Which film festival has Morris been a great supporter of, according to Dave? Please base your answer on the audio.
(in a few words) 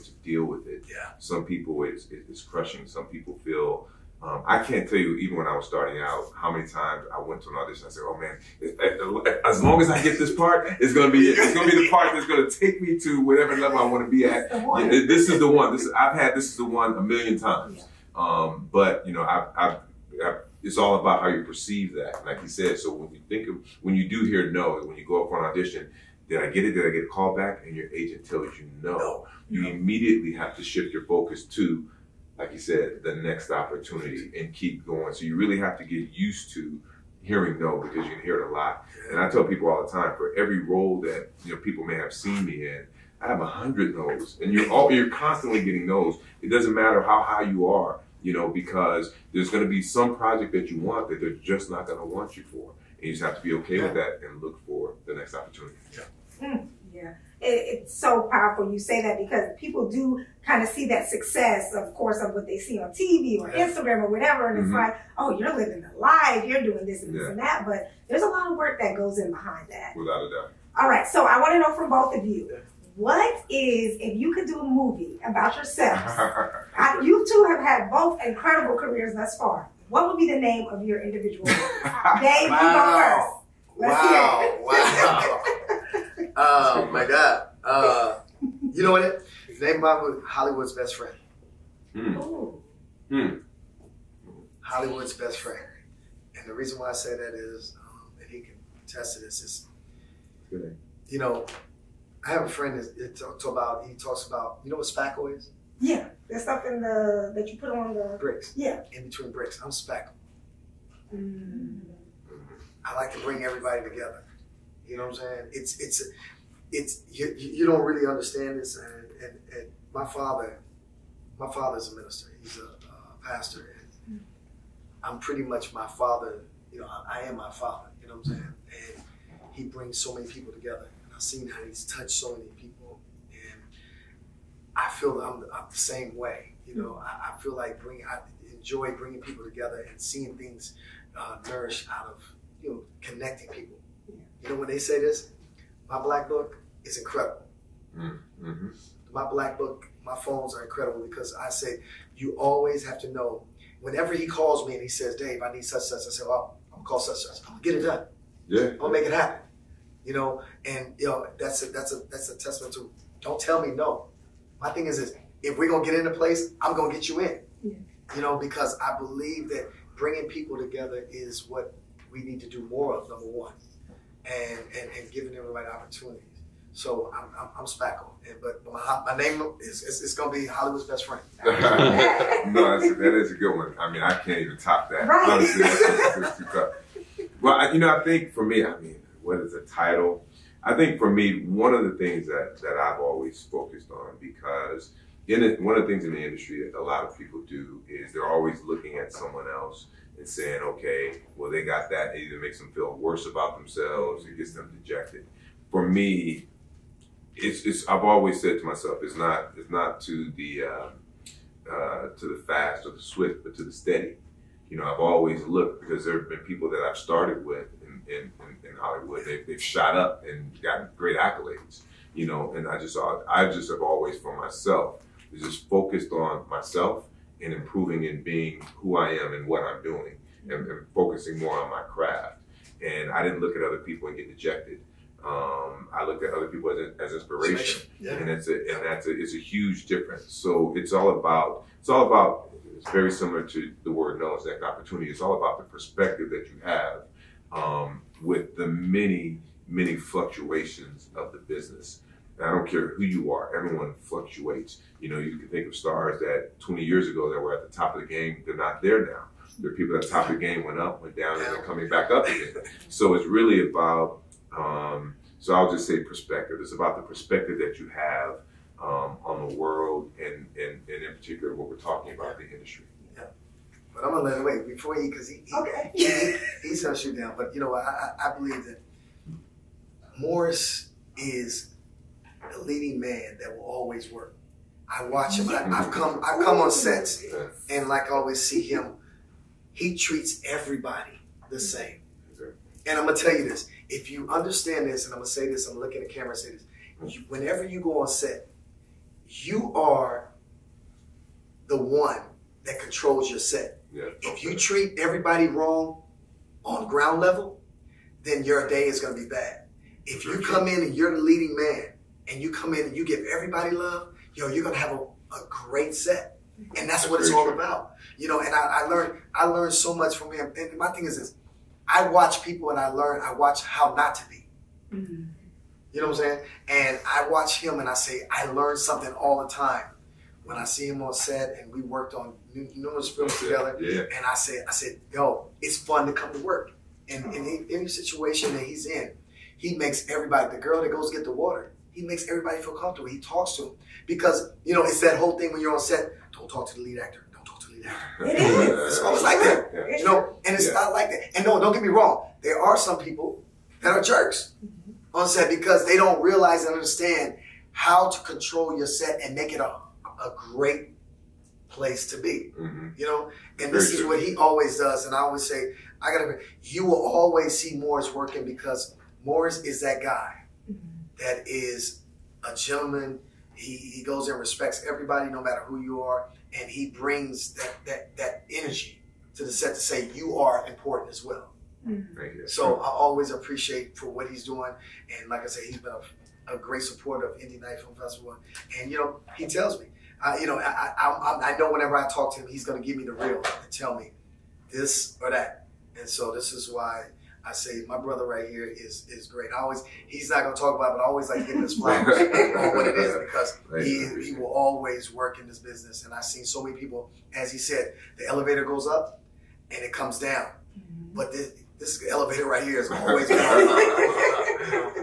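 Indie Night Film Festival.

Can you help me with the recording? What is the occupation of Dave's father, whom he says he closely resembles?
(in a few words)
Pastor.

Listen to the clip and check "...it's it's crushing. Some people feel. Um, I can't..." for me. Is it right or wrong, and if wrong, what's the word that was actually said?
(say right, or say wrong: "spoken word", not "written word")
right.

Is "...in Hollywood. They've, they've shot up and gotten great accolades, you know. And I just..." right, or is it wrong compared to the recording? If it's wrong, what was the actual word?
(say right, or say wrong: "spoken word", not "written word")
right.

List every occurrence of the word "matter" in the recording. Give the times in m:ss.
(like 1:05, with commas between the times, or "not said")
0:46, 6:15.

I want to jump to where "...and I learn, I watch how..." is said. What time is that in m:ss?
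5:22.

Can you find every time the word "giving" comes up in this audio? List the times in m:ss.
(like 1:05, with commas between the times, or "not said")
2:55, 6:41.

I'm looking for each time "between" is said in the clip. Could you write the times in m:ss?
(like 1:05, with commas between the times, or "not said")
1:49.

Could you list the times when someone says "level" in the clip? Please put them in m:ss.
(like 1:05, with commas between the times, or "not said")
0:13, 5:07.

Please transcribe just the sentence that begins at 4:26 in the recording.
It's about the perspective that you have um, on the world and, and, and in particular what we're talking about, the industry.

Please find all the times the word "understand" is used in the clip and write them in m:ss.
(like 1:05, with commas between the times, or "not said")
1:58, 4:54, 5:56.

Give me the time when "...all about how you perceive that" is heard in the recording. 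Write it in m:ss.
0:20.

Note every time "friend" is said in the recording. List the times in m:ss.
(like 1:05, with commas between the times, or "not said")
1:30, 1:35, 1:42, 3:01.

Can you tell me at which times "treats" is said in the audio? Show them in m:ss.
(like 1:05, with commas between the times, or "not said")
4:49, 5:04.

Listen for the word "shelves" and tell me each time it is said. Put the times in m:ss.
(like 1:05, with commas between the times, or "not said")
not said.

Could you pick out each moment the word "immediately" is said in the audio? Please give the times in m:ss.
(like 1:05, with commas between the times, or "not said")
0:29.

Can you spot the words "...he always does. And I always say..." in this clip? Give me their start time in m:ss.
6:04.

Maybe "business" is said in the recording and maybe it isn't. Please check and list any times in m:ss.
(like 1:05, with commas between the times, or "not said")
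4:11, 6:45.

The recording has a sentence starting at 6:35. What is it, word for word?
And so this is why I say my brother right here is is great.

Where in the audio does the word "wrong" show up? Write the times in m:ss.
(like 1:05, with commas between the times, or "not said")
5:05, 5:51.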